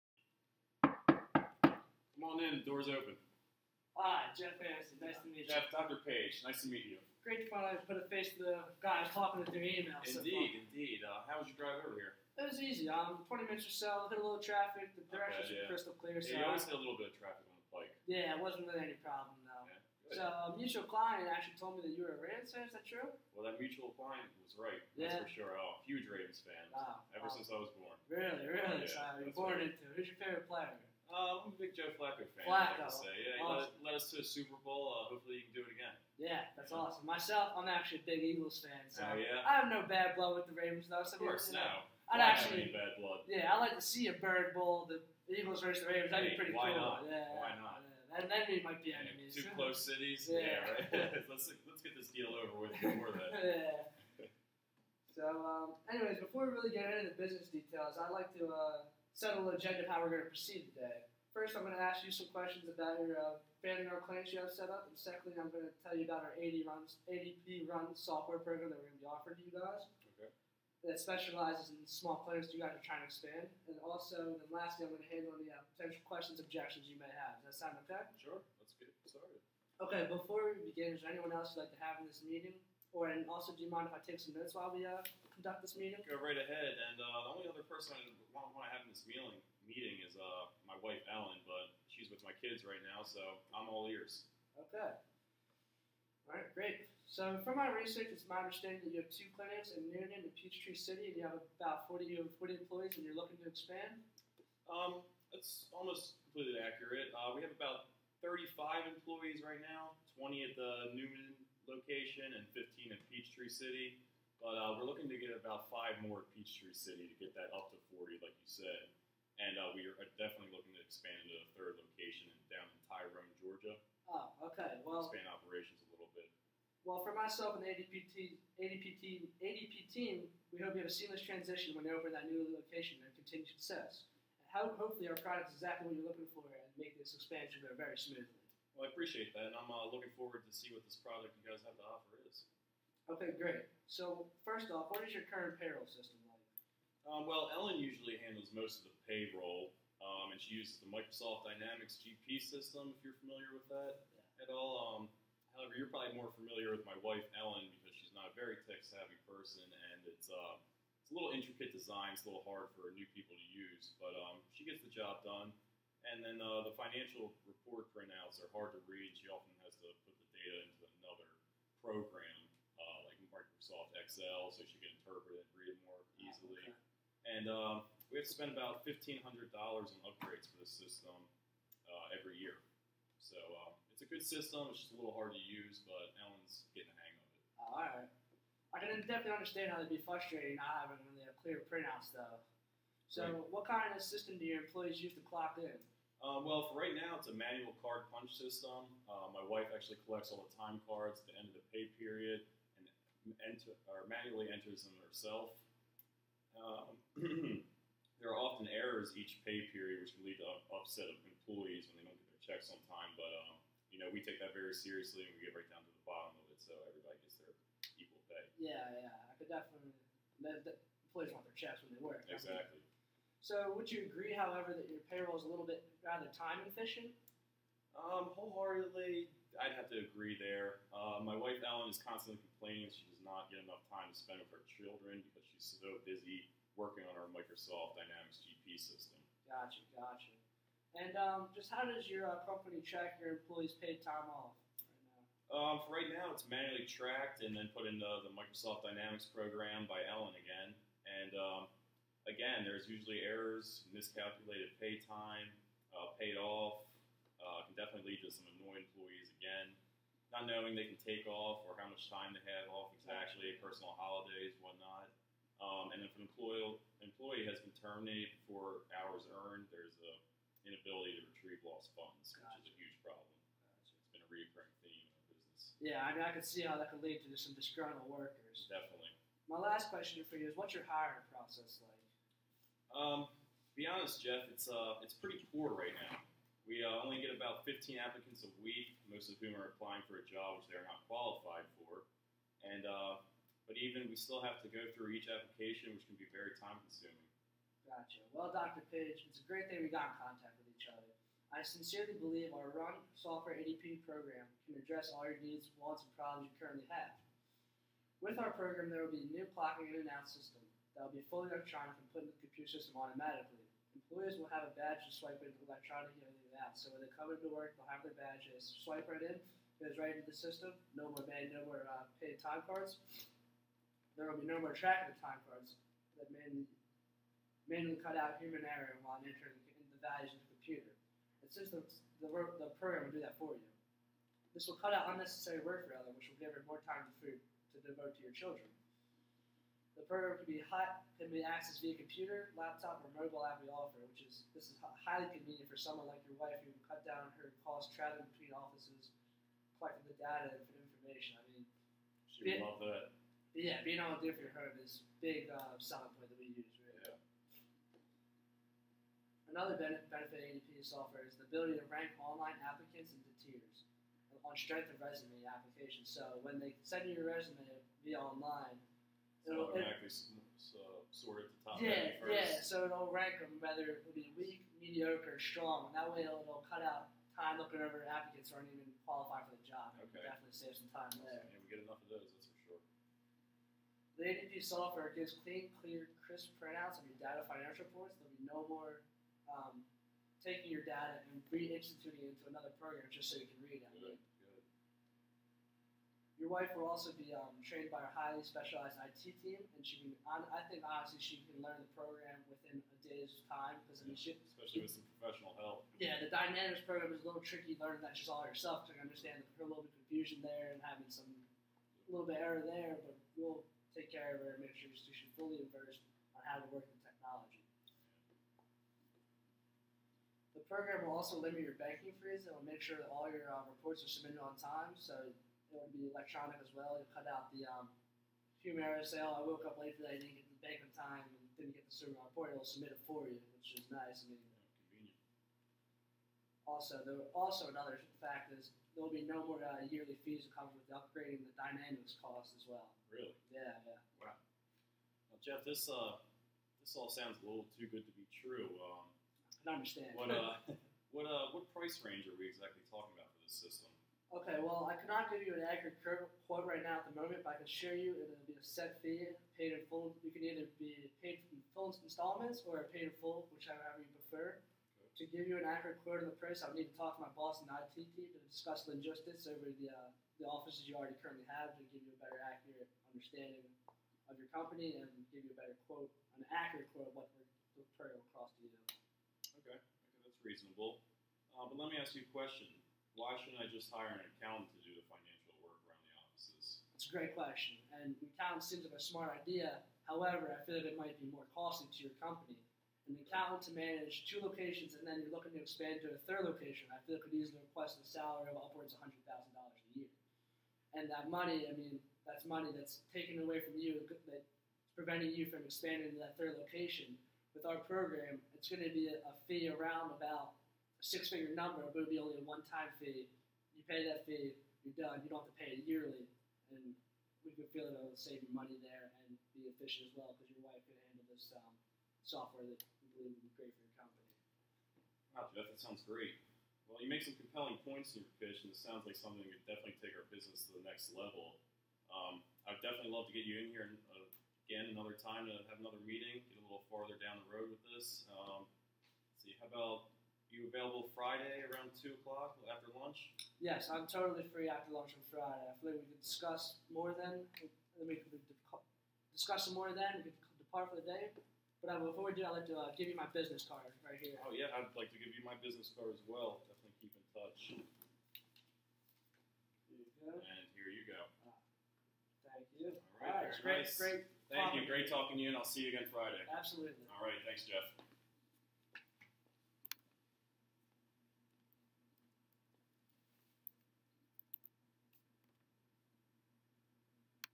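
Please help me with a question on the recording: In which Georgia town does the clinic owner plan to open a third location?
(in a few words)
Tyrone.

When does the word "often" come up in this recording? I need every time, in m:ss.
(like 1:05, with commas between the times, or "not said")
2:49, 3:28.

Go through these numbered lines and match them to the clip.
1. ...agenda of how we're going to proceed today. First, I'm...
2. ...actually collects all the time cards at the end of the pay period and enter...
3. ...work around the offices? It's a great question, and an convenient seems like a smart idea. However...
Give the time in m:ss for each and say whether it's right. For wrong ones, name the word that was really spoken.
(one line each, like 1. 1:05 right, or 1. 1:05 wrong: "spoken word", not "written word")
1. 0:59 right
2. 3:19 right
3. 8:05 wrong: "accountant", not "convenient".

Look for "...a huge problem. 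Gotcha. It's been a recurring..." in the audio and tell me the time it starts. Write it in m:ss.
4:32.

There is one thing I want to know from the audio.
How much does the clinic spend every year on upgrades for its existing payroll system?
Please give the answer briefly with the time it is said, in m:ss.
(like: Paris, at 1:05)
$1,500, at 2:58.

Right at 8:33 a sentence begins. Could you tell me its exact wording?
You pay that fee, you're done.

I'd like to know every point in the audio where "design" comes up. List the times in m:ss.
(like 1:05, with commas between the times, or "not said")
2:41.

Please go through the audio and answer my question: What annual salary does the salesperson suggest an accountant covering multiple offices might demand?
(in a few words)
$100,000.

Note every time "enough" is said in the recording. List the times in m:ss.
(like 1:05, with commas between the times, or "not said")
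3:53, 6:21.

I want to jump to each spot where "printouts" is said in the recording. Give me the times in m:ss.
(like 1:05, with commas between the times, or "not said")
2:47, 3:11, 6:26.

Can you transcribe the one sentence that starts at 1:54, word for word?
But uh, we're looking to get about five more at Peachtree City to get that up to 40, like you said.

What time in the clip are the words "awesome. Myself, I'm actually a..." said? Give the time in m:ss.
0:36.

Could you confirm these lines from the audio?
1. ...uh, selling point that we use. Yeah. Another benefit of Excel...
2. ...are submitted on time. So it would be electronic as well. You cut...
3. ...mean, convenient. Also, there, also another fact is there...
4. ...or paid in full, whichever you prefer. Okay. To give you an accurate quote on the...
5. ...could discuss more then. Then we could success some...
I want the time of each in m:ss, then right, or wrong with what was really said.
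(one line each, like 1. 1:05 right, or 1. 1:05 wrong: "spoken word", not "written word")
1. 5:55 wrong: "ADP", not "Excel"
2. 7:04 right
3. 7:14 right
4. 7:42 right
5. 9:06 wrong: "discuss", not "success".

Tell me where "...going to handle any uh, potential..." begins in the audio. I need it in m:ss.
1:14.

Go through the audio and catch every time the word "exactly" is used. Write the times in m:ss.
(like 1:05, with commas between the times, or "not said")
2:15, 3:42, 4:23, 7:32.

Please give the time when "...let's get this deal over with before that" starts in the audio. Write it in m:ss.
0:51.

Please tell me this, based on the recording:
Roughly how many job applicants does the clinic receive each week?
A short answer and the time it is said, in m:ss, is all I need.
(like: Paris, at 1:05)
15, at 4:47.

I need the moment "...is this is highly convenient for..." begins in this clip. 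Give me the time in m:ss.
5:44.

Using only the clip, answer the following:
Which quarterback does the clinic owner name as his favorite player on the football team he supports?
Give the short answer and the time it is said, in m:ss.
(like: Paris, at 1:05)
Joe Flacco, at 0:31.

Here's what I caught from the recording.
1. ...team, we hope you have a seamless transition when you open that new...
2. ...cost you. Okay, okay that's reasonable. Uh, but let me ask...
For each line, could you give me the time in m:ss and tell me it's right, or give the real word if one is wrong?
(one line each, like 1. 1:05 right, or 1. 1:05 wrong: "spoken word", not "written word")
1. 2:09 right
2. 7:58 right.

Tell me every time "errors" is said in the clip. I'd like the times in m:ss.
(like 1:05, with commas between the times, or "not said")
3:28, 4:13, 5:28, 6:52.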